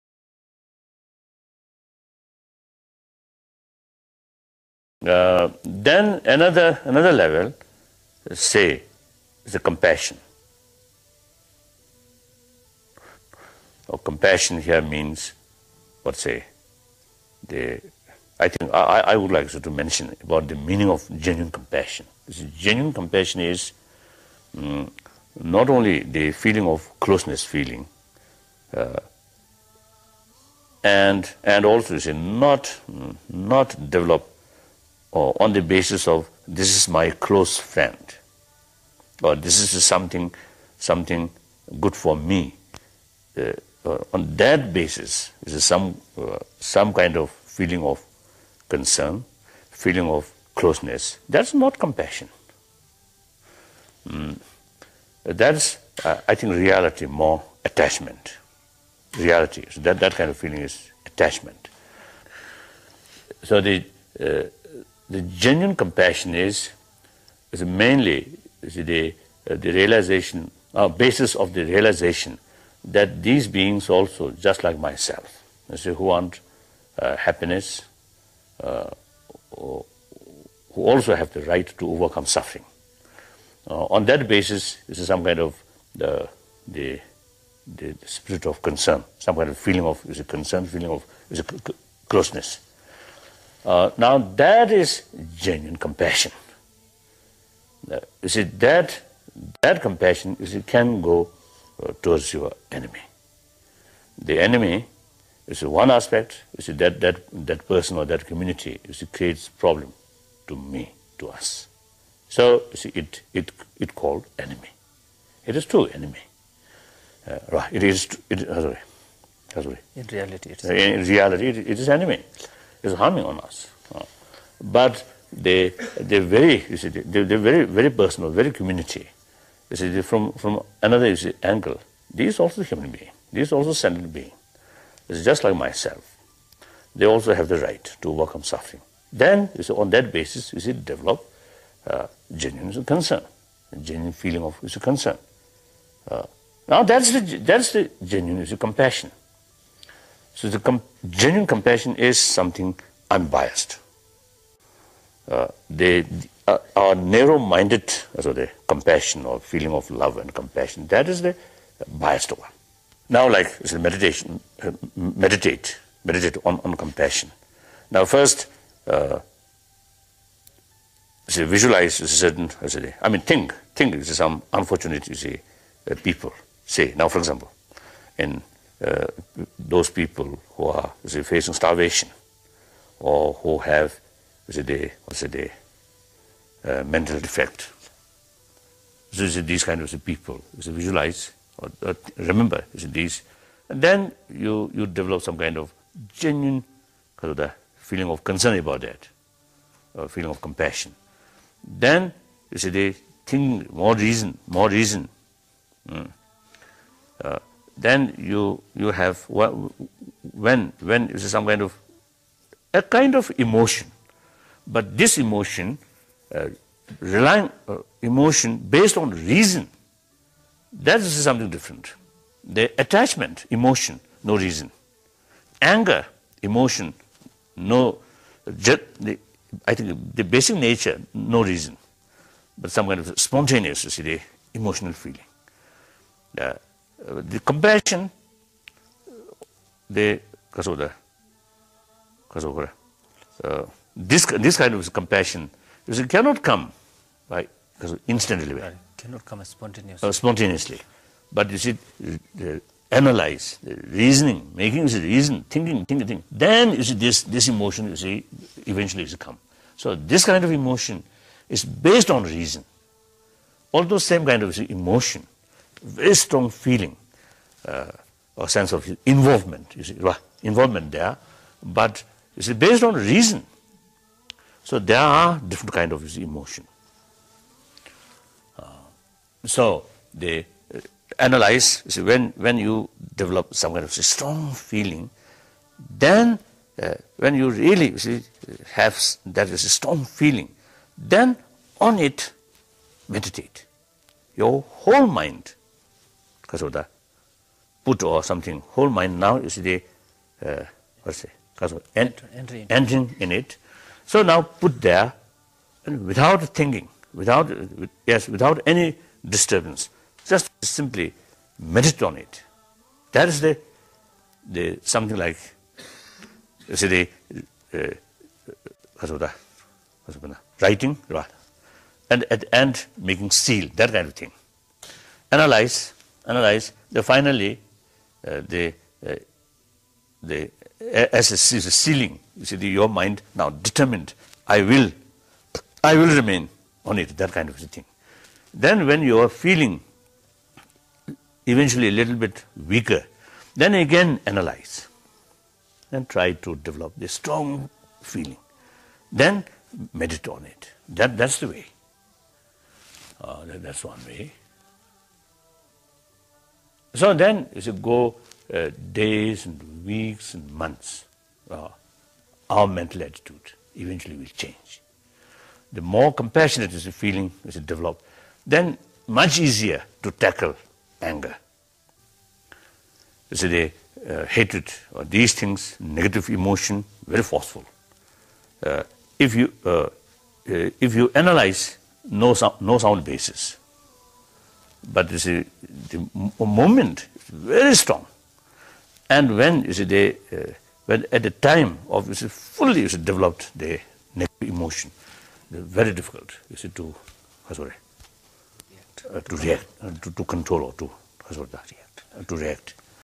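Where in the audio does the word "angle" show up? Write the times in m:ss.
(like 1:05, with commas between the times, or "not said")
2:11.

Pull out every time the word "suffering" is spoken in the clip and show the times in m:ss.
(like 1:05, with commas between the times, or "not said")
1:22, 2:18.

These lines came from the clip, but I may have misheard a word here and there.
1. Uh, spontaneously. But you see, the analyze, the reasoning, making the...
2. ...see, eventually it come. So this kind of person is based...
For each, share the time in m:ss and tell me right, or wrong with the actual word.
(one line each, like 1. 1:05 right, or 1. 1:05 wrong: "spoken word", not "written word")
1. 4:10 right
2. 4:17 wrong: "emotion", not "person".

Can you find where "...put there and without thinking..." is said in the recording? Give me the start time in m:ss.
5:04.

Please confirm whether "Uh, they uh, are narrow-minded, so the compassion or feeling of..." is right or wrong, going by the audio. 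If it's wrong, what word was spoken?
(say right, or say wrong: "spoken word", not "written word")
right.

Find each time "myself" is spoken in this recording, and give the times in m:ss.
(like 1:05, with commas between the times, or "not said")
1:14, 2:15.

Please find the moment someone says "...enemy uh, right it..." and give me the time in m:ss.
1:55.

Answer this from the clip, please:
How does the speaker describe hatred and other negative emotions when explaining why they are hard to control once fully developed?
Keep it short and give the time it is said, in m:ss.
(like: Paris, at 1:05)
very forceful, at 6:17.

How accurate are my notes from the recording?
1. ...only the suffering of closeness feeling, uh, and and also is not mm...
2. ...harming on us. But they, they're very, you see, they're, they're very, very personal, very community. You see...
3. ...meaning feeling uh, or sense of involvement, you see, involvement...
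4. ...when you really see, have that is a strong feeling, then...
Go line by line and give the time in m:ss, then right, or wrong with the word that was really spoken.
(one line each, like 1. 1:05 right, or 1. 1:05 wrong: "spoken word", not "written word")
1. 0:25 wrong: "feeling", not "suffering"
2. 2:02 right
3. 4:26 wrong: "strong", not "meaning"
4. 4:47 right.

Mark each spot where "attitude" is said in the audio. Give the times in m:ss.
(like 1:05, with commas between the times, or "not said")
6:03.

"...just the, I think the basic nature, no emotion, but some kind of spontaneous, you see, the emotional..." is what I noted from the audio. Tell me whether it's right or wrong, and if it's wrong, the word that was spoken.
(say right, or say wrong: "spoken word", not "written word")
wrong: "reason", not "emotion".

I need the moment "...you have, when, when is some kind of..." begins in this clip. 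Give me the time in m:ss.
3:28.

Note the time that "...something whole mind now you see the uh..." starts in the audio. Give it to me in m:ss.
4:58.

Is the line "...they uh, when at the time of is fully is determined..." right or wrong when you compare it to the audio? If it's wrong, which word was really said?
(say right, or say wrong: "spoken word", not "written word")
wrong: "developed", not "determined".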